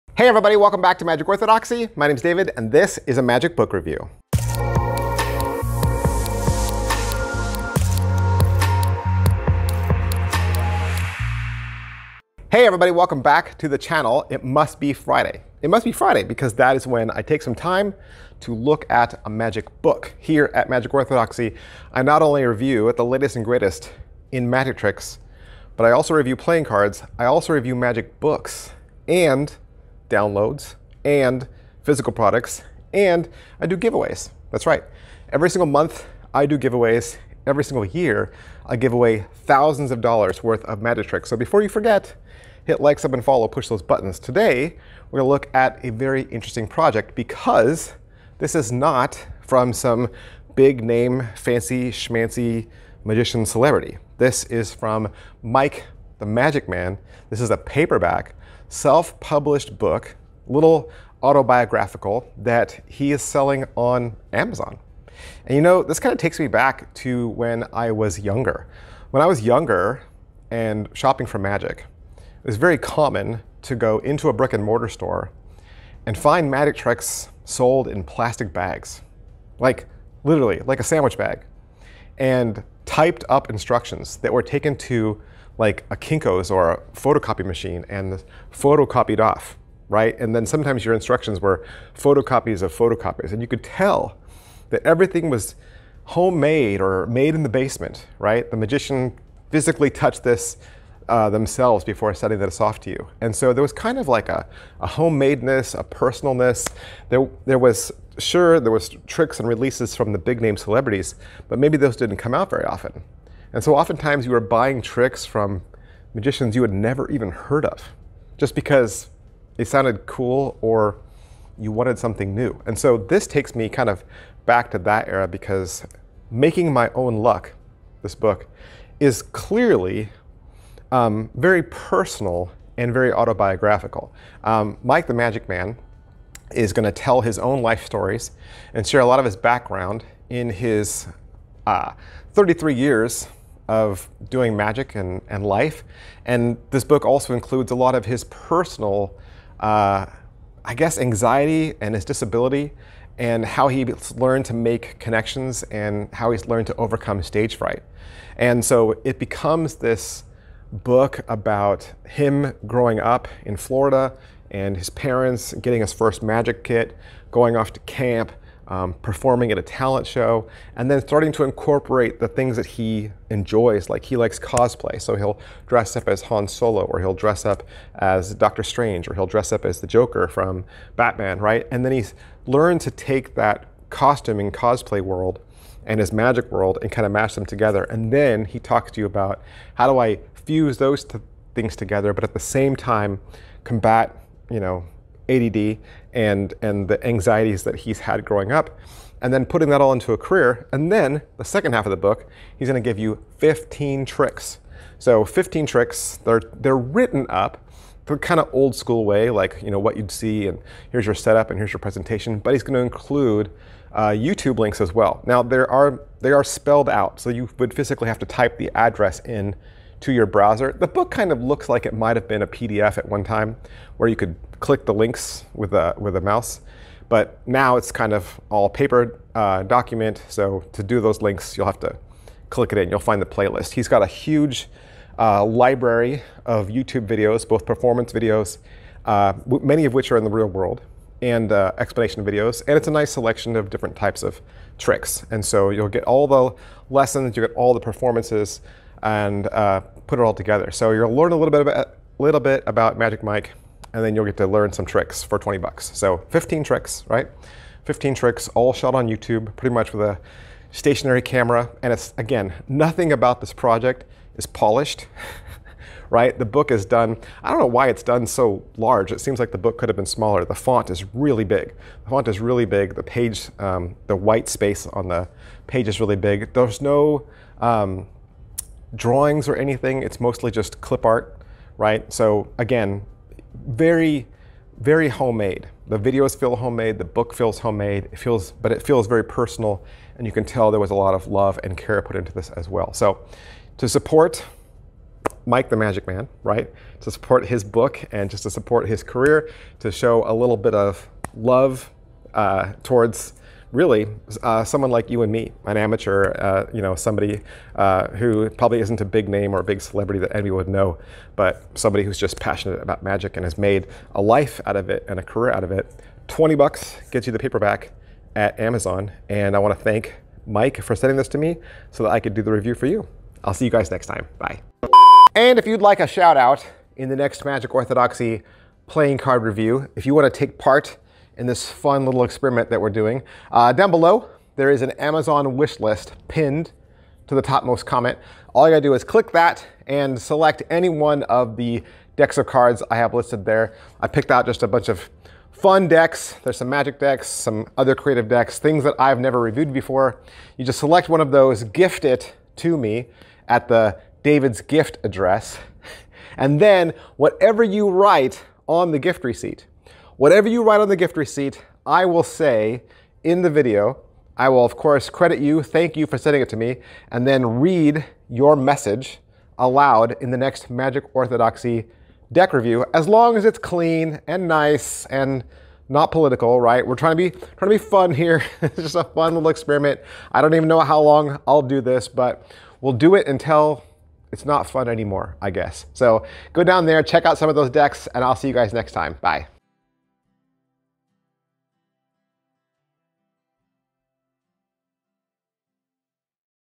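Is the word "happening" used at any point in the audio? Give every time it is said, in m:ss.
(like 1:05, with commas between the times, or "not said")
not said.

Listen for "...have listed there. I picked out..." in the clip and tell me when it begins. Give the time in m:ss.
5:42.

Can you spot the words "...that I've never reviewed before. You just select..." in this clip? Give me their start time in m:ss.
5:48.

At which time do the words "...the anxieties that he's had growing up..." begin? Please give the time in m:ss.
3:16.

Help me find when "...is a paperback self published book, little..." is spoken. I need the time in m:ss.
0:57.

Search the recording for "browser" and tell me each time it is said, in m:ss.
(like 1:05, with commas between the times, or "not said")
3:40.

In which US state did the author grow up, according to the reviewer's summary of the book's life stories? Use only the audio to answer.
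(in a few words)
Florida.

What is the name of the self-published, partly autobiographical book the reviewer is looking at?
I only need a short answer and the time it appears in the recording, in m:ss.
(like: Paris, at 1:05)
Making My Own Luck, at 2:06.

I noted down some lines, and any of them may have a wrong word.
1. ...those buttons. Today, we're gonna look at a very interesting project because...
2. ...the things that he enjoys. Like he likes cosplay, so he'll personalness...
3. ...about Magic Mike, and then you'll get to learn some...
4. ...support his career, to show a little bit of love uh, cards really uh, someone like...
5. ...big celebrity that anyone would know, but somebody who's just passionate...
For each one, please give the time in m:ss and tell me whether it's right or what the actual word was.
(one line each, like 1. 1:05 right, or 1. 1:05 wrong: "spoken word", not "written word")
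1. 0:43 right
2. 2:52 wrong: "dress", not "personalness"
3. 4:12 right
4. 4:58 wrong: "towards", not "cards"
5. 5:09 right.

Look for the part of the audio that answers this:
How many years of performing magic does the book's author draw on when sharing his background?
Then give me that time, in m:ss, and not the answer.
2:22.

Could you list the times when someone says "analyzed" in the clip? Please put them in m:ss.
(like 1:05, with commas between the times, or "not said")
not said.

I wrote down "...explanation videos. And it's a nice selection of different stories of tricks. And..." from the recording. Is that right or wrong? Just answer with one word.
wrong.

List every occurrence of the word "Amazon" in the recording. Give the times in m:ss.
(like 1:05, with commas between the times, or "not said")
1:04, 5:18, 5:34.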